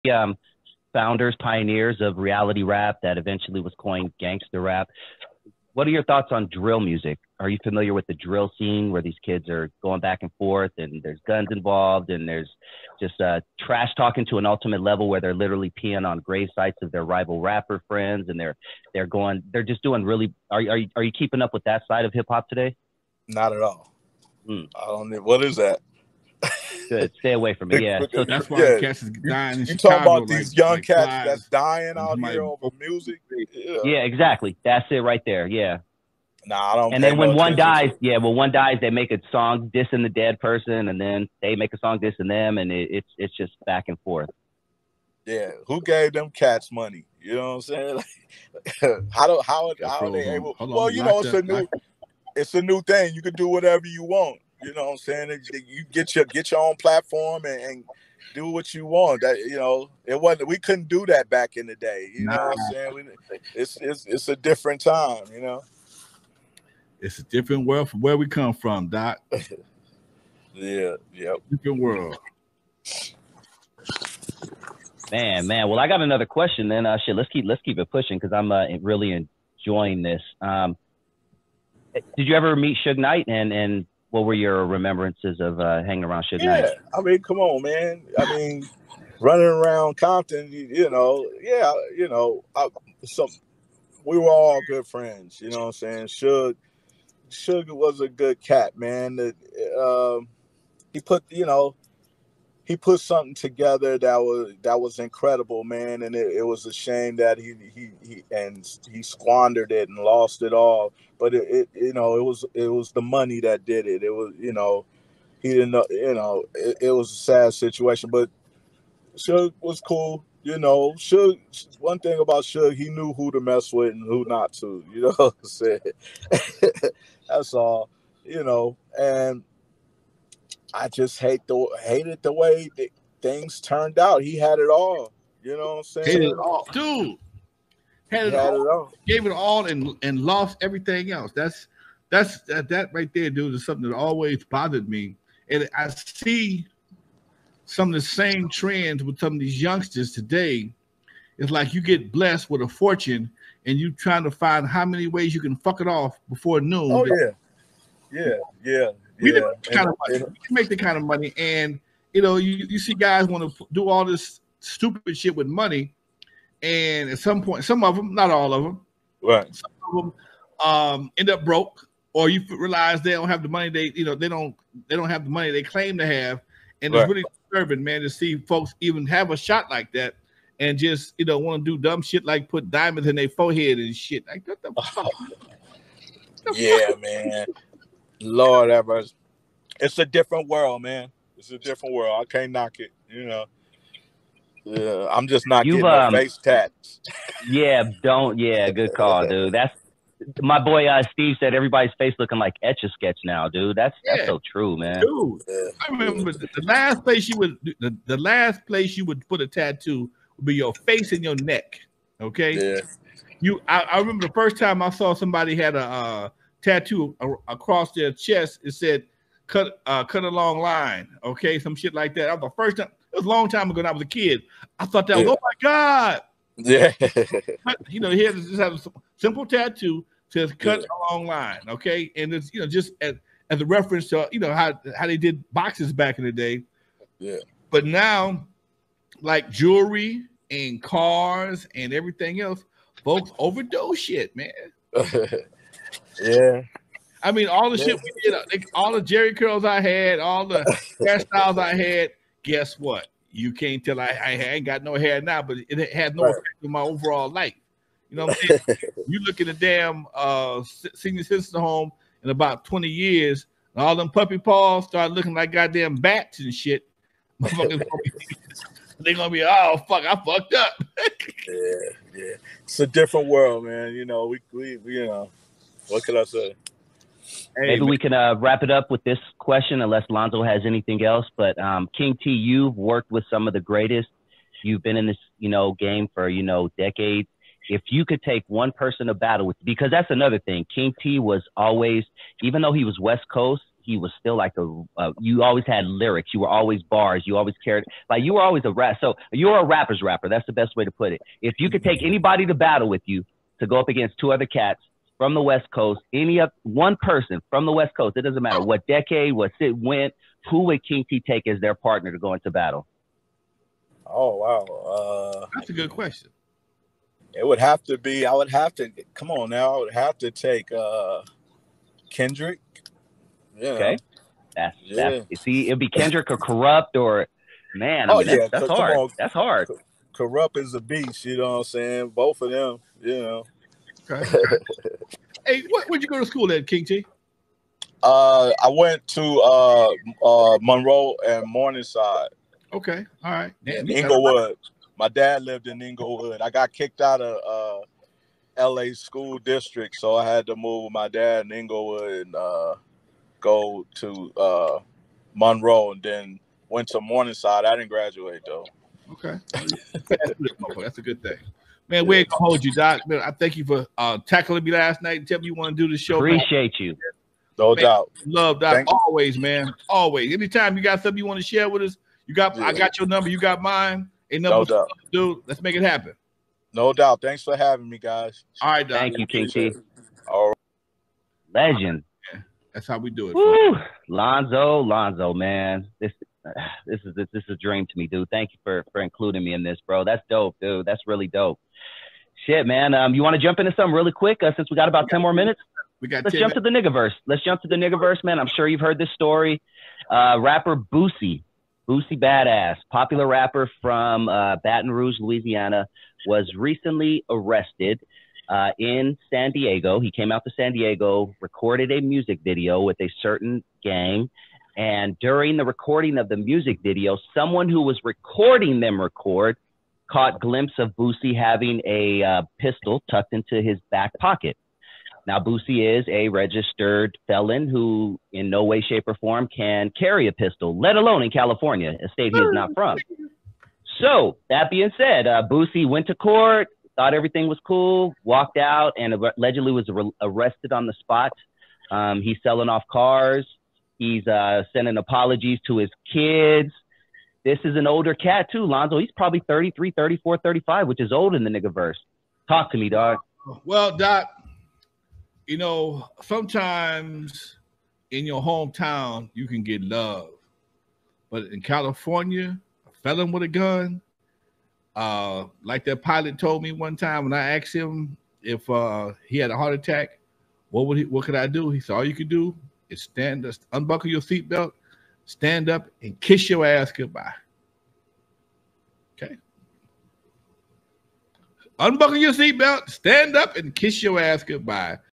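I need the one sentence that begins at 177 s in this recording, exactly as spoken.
it's really disturbing, man, to see folks even have a shot like that.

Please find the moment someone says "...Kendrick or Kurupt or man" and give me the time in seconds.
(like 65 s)
325 s.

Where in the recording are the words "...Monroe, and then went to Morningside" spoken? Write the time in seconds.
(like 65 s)
355 s.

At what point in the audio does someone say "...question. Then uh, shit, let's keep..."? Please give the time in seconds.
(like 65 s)
76 s.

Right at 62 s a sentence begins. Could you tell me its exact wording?
We, it's it's it's a different time.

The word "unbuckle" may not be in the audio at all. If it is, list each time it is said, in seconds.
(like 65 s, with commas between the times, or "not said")
473 s, 481 s.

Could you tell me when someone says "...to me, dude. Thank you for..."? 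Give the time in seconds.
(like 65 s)
387 s.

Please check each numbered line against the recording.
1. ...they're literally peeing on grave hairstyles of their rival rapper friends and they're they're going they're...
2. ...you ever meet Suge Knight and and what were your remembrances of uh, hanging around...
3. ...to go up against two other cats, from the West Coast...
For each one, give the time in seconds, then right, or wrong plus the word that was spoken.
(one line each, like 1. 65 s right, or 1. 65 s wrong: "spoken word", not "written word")
1. 15 s wrong: "sites", not "hairstyles"
2. 82 s right
3. 303 s right.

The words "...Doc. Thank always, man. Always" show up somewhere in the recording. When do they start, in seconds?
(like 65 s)
368 s.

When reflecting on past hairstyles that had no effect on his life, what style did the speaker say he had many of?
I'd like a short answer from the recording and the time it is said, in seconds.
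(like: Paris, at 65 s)
Jheri curls, at 249 s.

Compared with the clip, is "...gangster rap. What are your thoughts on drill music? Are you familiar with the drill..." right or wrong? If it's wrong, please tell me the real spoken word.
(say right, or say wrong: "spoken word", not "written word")
right.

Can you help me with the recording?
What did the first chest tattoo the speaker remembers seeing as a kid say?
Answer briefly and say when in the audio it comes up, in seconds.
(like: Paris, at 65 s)
Cut a long line, at 220 s.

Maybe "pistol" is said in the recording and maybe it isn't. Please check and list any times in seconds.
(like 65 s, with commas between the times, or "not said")
422 s, 430 s.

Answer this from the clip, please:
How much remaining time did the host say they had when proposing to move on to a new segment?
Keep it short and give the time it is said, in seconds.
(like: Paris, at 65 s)
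10 minutes, at 395 s.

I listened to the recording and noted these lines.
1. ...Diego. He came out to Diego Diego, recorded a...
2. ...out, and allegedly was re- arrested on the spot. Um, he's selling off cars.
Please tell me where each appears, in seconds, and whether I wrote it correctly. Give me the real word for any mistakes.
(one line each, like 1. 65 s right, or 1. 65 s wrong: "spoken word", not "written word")
1. 409 s wrong: "San", not "Diego"
2. 438 s right.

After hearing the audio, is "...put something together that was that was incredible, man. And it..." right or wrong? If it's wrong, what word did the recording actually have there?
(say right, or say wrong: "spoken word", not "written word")
right.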